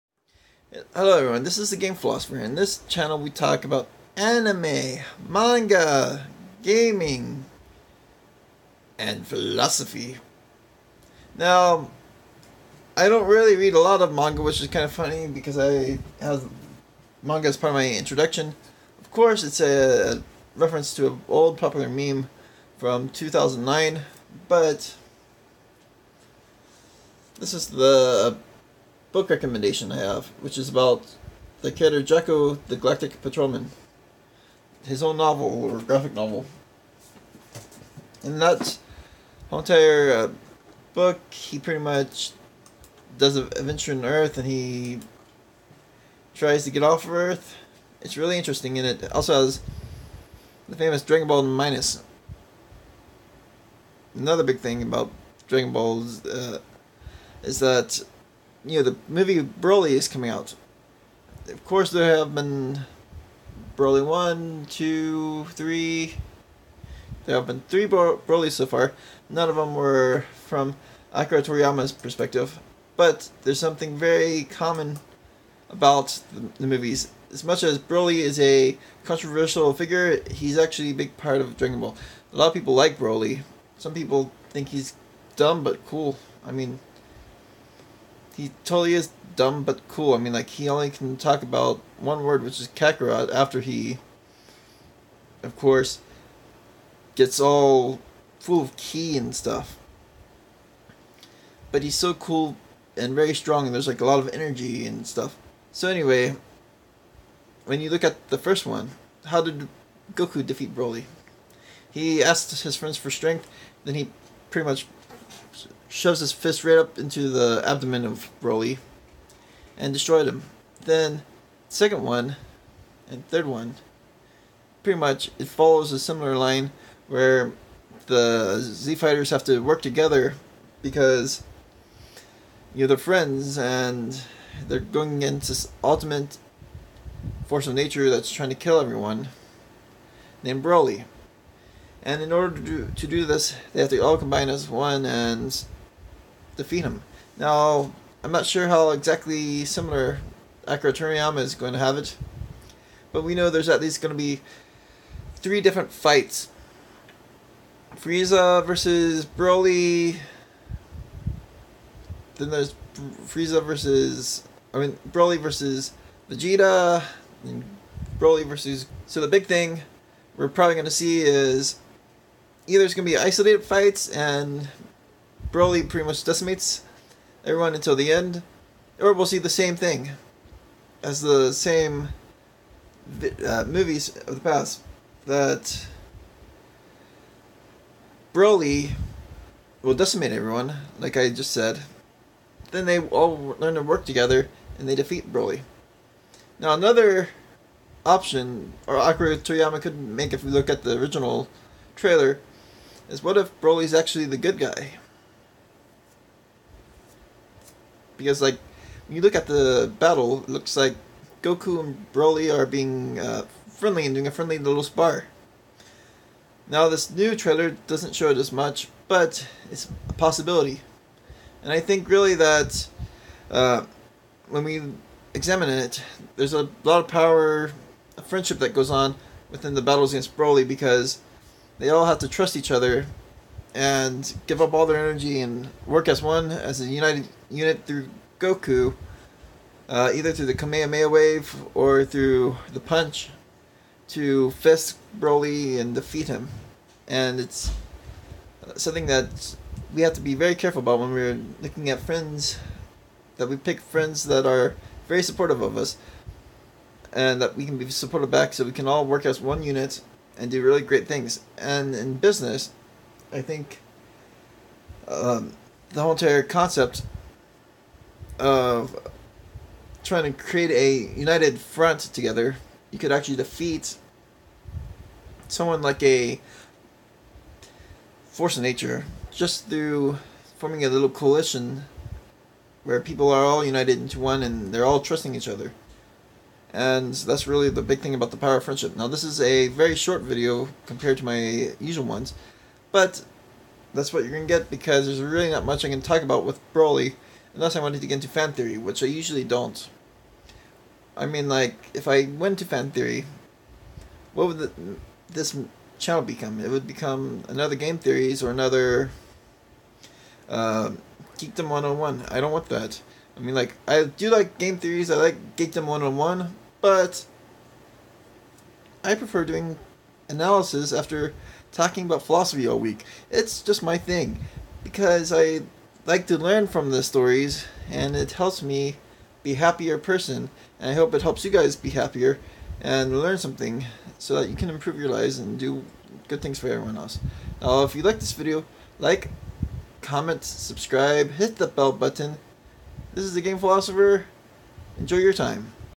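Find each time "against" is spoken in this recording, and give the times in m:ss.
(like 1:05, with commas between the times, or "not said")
2:15, 3:50.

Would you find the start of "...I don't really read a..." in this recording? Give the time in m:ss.
0:12.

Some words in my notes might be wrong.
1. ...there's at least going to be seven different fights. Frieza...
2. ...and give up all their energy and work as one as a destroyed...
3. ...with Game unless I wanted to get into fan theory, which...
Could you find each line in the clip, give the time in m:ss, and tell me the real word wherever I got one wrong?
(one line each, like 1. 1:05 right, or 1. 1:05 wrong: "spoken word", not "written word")
1. 2:33 wrong: "three", not "seven"
2. 3:53 wrong: "united", not "destroyed"
3. 4:56 wrong: "Broly", not "Game".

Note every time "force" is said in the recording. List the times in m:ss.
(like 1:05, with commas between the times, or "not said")
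2:17, 4:38.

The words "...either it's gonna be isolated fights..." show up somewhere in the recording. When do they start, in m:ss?
2:52.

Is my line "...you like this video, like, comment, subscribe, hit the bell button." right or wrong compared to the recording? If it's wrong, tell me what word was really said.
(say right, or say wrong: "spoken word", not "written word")
right.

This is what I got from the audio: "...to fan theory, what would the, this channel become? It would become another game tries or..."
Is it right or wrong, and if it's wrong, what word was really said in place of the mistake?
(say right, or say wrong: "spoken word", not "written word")
wrong: "theories", not "tries".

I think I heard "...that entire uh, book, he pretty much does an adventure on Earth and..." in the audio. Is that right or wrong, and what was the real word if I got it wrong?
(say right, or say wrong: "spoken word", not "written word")
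right.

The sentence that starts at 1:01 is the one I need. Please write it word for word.
Of course, there have been Broly 1, 2, 3.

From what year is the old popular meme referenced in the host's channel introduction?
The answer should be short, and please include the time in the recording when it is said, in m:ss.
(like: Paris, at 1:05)
2009, at 0:23.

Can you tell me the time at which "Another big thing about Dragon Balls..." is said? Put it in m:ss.
0:54.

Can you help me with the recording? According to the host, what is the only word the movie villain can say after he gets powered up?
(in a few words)
Kakarot.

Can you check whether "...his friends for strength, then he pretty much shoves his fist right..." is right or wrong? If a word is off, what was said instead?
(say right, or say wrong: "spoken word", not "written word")
right.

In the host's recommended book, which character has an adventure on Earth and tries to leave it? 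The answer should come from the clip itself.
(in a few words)
Jaco the Galactic Patrolman.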